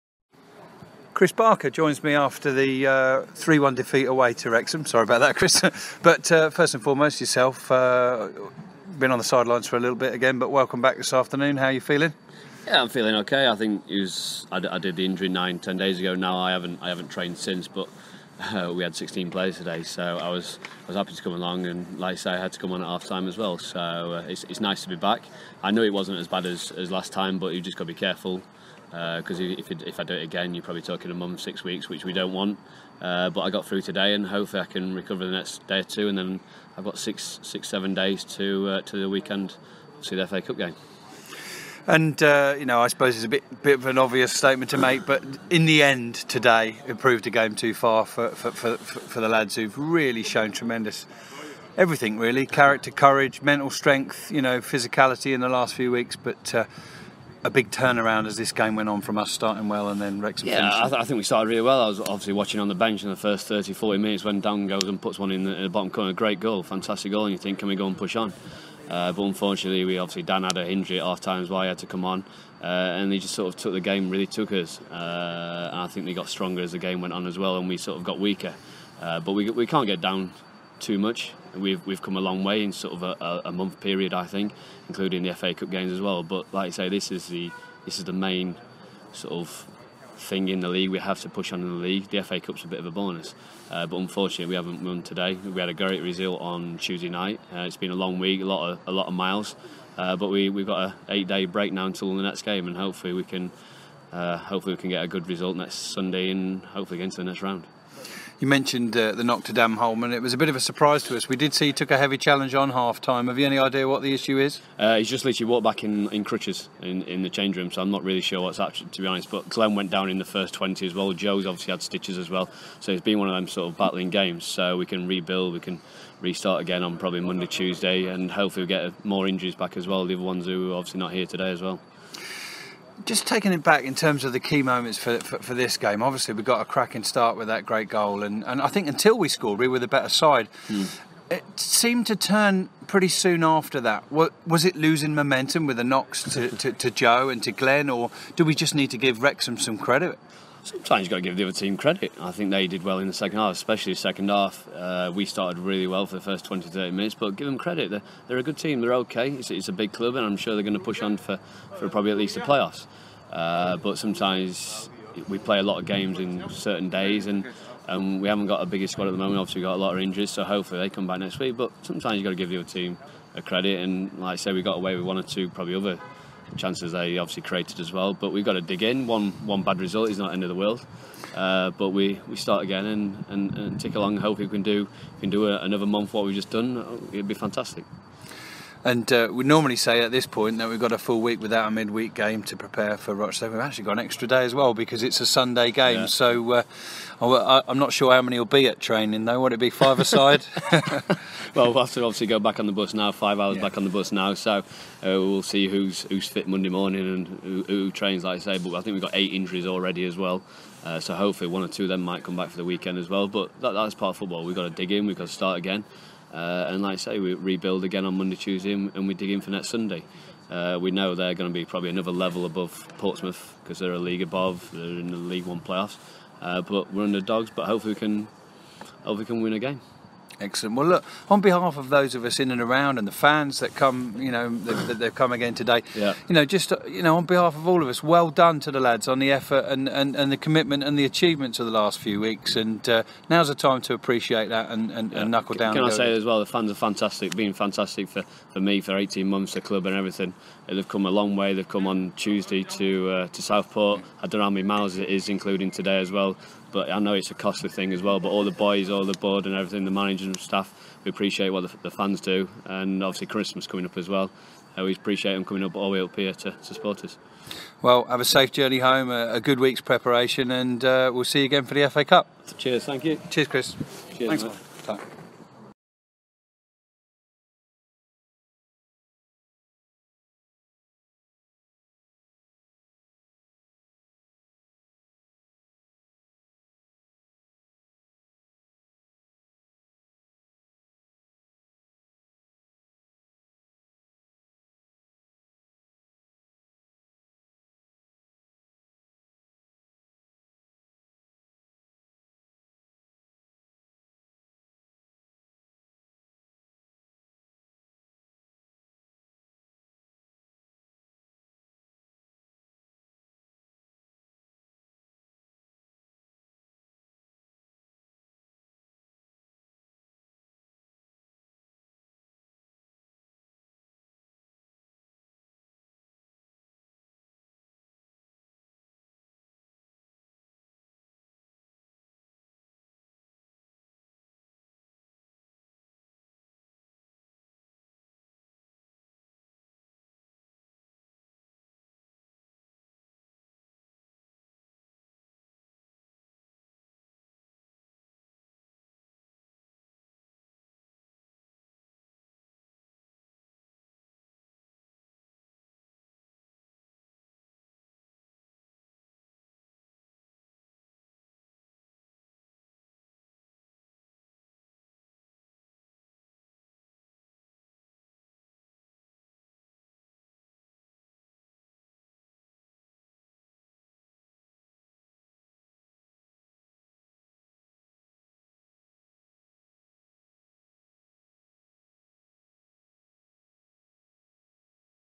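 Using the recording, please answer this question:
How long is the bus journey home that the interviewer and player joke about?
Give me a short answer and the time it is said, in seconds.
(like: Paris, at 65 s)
5 hours, at 203 s.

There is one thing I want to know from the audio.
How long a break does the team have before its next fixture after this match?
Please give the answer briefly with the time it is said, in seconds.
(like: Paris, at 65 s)
8 days, at 101 s.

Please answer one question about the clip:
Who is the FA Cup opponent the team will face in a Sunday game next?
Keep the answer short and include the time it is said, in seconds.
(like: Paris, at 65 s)
Rochdale, at 193 s.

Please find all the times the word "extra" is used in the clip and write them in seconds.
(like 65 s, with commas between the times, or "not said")
193 s.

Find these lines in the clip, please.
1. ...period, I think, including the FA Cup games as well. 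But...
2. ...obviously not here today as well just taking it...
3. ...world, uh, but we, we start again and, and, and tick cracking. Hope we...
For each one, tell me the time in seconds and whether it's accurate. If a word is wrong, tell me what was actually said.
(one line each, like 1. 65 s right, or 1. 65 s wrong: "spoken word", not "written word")
1. 83 s right
2. 130 s right
3. 180 s wrong: "along", not "cracking".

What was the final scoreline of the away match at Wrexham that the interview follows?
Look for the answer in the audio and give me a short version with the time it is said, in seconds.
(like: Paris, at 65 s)
3-1, at 3 s.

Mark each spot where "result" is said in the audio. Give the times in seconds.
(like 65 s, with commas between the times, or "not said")
96 s, 105 s, 179 s.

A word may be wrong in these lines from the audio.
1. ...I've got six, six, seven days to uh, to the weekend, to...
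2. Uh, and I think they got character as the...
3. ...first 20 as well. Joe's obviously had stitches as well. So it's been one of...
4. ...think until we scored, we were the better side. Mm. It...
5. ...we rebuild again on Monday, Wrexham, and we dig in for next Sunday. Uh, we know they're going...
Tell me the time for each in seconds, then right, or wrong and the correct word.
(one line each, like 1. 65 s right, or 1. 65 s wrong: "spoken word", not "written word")
1. 36 s right
2. 74 s wrong: "stronger", not "character"
3. 120 s right
4. 138 s right
5. 217 s wrong: "Tuesday", not "Wrexham".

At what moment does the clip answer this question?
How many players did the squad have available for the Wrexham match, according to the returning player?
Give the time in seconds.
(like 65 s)
18 s.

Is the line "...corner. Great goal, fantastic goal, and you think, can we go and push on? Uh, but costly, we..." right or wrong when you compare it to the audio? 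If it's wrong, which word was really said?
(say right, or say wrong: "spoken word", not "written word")
wrong: "unfortunately", not "costly".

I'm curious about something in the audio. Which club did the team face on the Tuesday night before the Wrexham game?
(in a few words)
Southport.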